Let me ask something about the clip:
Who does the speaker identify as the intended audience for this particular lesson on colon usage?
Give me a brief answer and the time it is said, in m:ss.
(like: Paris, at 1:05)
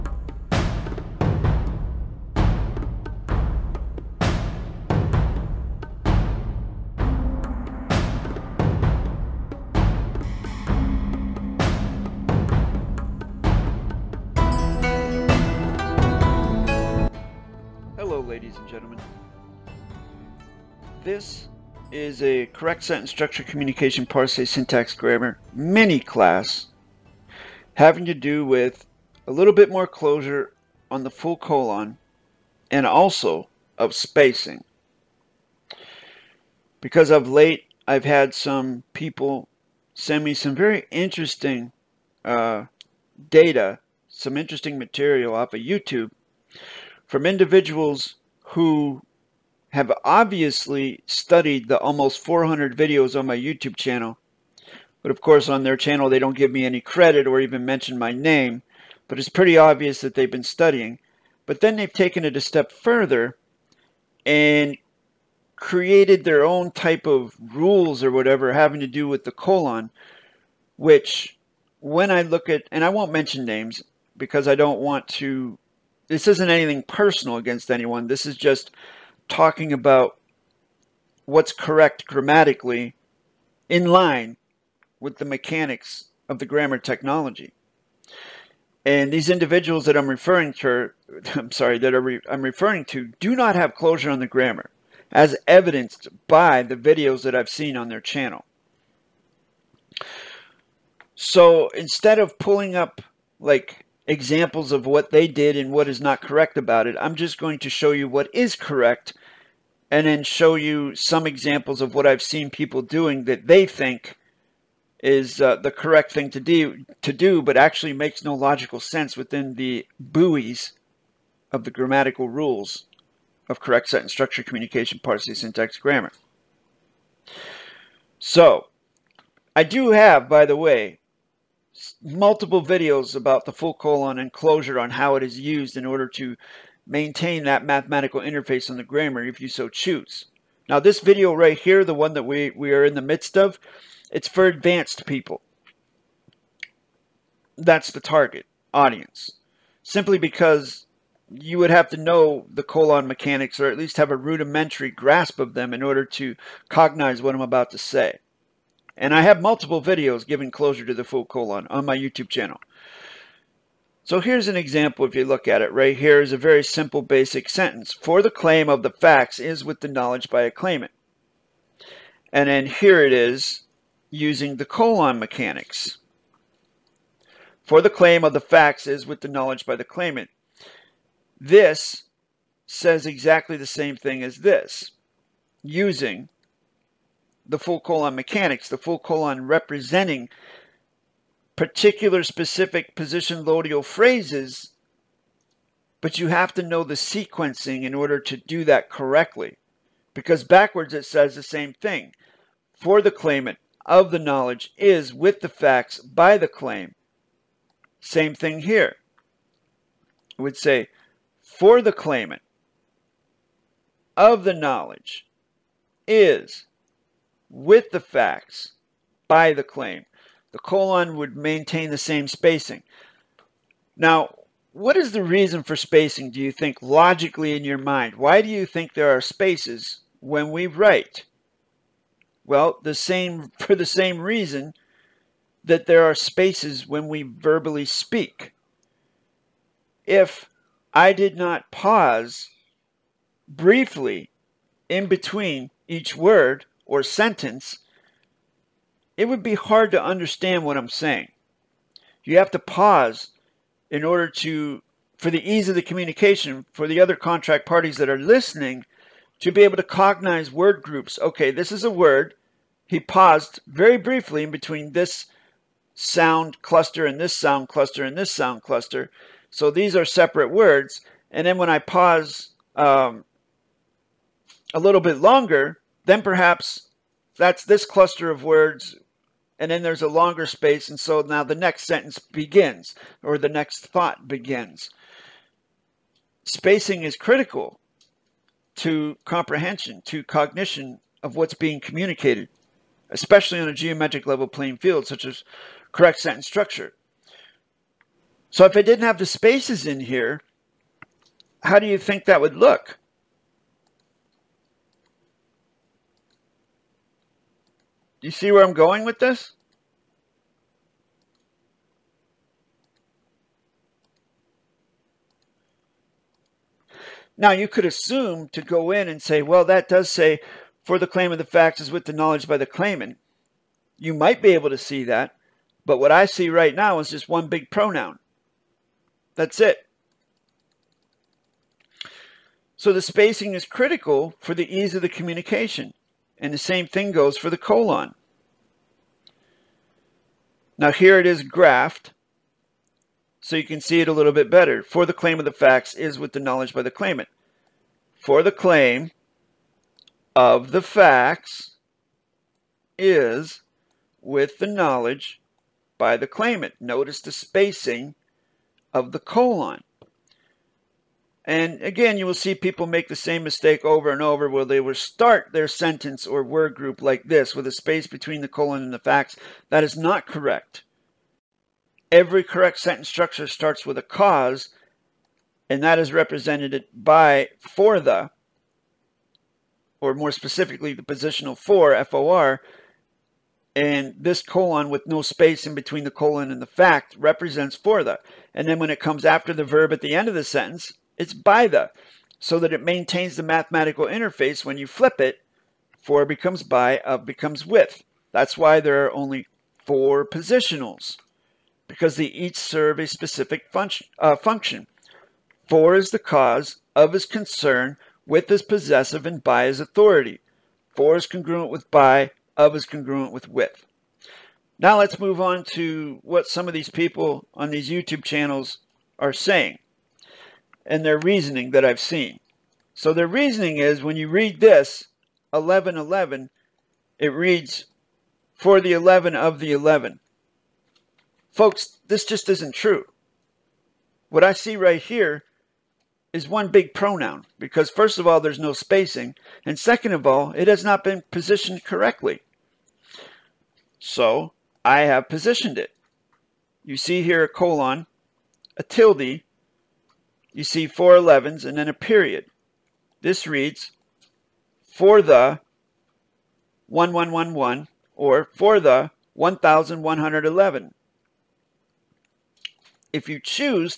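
advanced people, at 2:24.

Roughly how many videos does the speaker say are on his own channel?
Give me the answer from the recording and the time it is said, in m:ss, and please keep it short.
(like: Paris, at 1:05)
almost 400, at 0:51.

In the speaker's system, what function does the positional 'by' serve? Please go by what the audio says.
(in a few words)
authority.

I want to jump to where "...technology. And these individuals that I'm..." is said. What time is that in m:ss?
1:26.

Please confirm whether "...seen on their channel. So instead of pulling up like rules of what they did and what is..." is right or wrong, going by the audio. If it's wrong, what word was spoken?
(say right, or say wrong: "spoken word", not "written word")
wrong: "examples", not "rules".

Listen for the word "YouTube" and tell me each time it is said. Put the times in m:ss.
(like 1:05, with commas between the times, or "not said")
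0:45, 0:53, 2:41, 6:57.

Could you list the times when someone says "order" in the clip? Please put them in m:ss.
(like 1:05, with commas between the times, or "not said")
2:15, 2:35, 3:17, 4:14.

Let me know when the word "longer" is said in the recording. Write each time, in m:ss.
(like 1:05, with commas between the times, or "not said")
4:35, 4:40.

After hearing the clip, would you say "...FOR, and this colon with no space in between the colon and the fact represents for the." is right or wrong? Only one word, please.
right.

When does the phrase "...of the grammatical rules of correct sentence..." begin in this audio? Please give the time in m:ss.
2:01.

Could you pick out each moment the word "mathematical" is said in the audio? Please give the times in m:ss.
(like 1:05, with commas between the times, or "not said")
2:17, 6:33.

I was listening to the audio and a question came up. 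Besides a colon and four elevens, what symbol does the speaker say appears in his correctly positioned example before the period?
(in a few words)
a tilde.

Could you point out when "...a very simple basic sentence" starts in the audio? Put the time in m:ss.
2:46.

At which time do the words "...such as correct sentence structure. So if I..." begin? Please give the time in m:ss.
4:55.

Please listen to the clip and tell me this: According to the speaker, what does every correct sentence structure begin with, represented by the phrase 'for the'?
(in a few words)
a cause.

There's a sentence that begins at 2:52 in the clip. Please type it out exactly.
And then here it is using the colon mechanics.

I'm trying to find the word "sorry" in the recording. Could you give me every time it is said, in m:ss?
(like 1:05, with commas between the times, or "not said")
1:31.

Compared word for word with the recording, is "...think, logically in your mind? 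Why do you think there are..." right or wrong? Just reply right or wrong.
right.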